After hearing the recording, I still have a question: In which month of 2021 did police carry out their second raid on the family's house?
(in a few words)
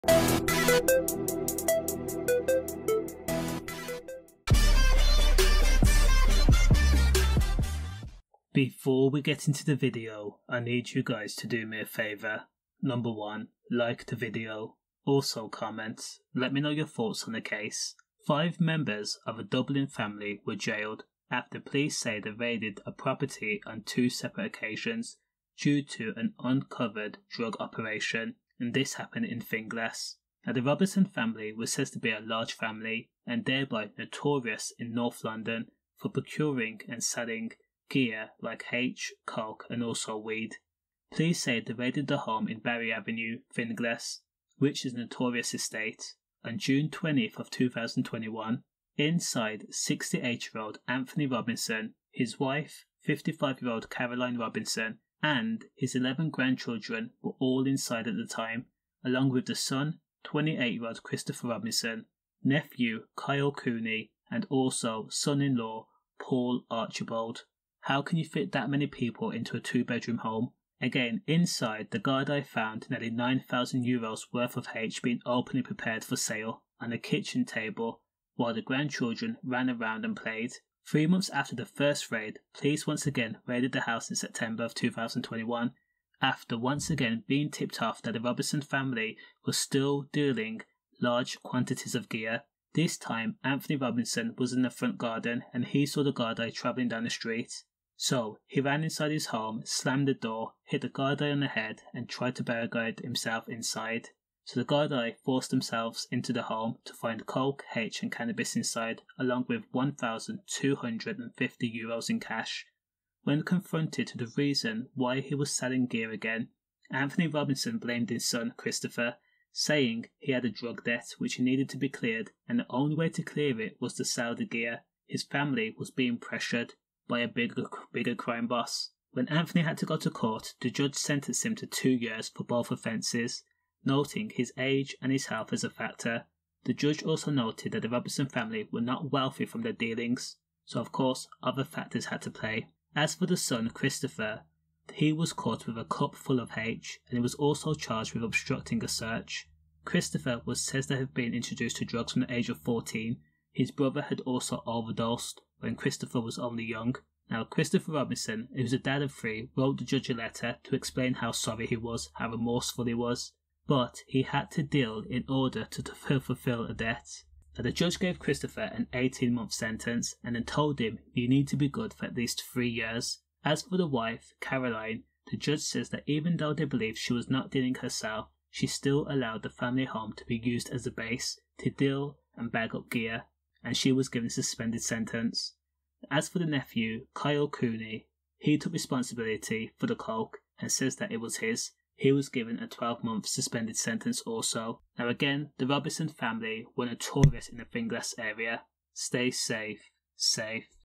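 September.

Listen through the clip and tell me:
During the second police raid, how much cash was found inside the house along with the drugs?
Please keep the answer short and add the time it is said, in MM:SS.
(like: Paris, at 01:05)
1,250 euros, at 01:49.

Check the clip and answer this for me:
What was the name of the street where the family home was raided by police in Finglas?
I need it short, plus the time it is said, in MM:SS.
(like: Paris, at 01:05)
Barry Avenue, at 00:42.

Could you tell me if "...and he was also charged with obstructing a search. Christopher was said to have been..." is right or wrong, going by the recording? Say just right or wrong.
right.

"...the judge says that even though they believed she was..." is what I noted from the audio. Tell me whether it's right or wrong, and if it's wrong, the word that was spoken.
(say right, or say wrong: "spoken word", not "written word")
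right.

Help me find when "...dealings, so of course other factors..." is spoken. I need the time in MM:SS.
02:19.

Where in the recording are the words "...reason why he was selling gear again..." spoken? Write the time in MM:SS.
01:54.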